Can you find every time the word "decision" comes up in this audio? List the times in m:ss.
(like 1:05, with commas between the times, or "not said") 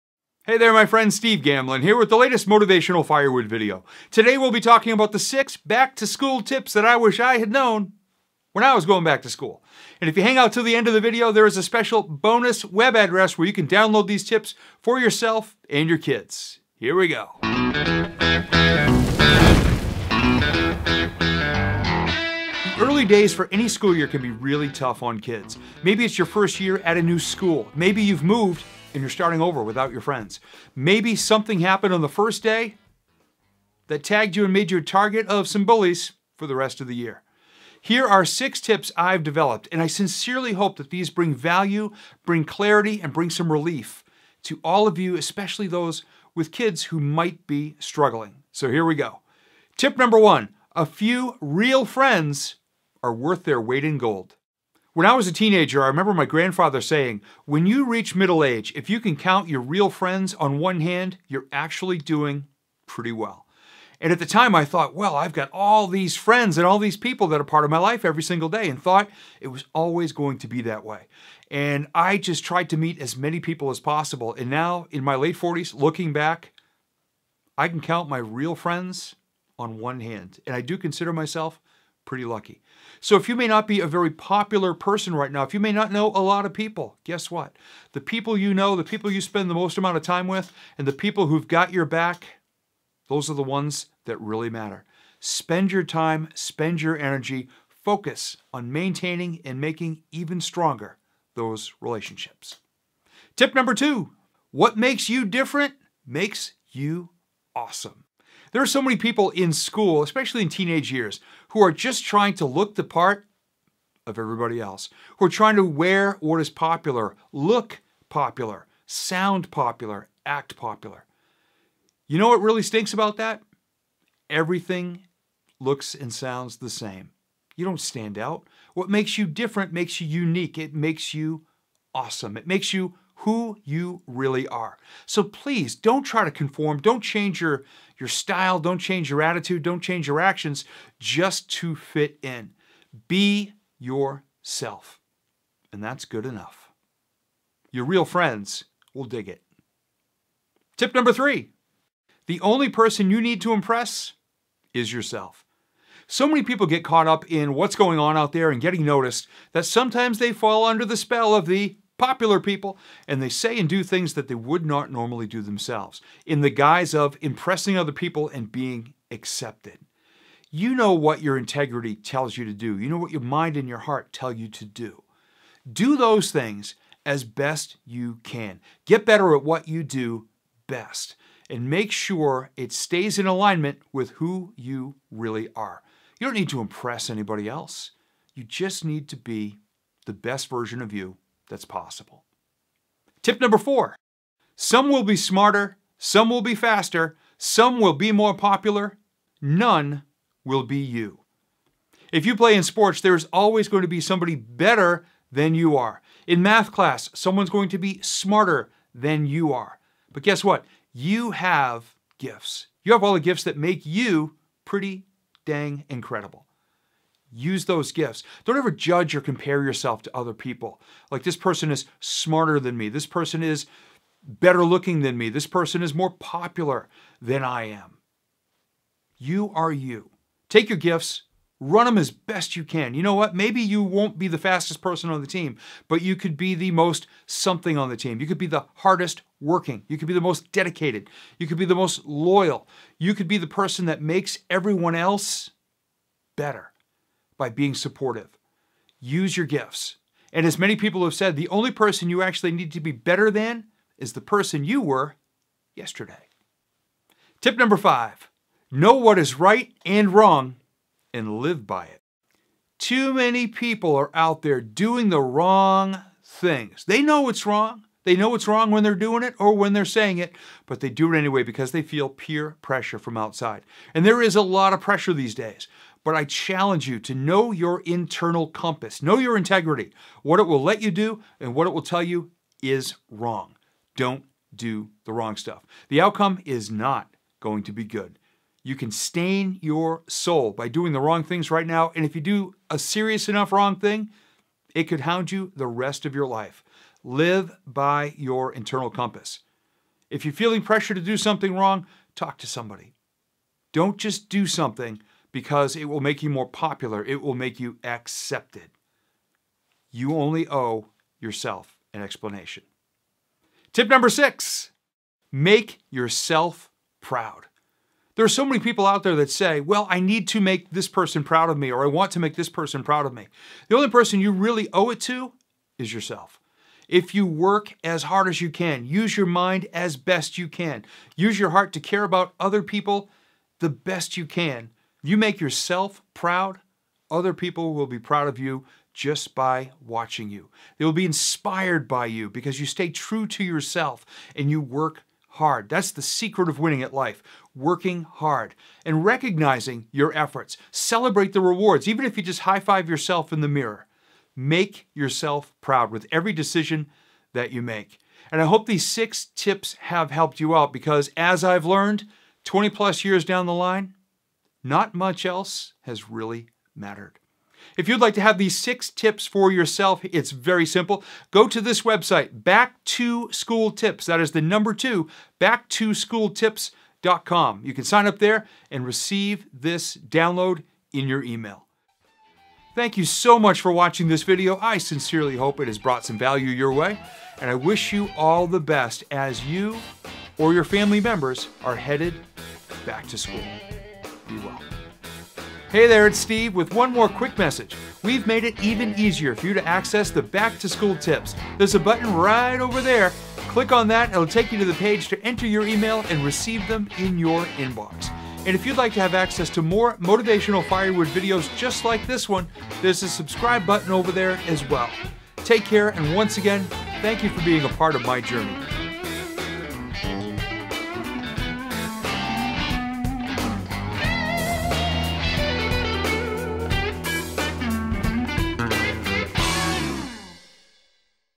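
5:56.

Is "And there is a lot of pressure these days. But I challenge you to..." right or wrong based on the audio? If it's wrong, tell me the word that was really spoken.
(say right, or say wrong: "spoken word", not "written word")
right.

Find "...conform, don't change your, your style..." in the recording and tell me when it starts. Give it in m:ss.
2:16.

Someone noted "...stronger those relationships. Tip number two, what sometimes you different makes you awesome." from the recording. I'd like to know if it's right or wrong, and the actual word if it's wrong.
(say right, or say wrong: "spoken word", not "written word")
wrong: "makes", not "sometimes".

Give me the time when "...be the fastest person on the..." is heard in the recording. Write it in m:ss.
3:54.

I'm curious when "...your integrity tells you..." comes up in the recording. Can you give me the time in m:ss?
2:51.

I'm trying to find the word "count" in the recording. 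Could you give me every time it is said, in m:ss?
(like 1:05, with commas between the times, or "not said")
0:59, 1:17.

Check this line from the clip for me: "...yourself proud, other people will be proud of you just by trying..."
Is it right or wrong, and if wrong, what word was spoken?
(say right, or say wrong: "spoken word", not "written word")
wrong: "watching", not "trying".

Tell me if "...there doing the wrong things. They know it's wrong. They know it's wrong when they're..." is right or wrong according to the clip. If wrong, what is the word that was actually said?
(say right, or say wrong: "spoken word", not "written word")
right.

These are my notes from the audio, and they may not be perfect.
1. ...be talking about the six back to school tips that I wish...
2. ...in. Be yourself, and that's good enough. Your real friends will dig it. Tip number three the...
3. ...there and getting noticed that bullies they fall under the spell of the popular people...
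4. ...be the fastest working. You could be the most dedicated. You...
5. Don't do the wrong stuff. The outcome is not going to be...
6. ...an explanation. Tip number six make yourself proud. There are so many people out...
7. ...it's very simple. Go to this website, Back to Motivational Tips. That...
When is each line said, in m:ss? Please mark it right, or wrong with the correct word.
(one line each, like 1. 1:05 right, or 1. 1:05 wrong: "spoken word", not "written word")
1. 0:04 right
2. 2:22 right
3. 2:38 wrong: "sometimes", not "bullies"
4. 3:58 wrong: "hardest", not "fastest"
5. 4:43 right
6. 5:11 right
7. 6:10 wrong: "School", not "Motivational".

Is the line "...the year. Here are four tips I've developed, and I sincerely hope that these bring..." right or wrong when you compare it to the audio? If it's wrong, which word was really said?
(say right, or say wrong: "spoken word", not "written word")
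wrong: "six", not "four".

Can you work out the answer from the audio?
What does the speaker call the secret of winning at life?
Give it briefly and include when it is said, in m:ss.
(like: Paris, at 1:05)
Working hard, at 5:47.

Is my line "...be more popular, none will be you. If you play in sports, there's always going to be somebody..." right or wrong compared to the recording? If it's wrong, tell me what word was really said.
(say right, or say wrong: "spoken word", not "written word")
right.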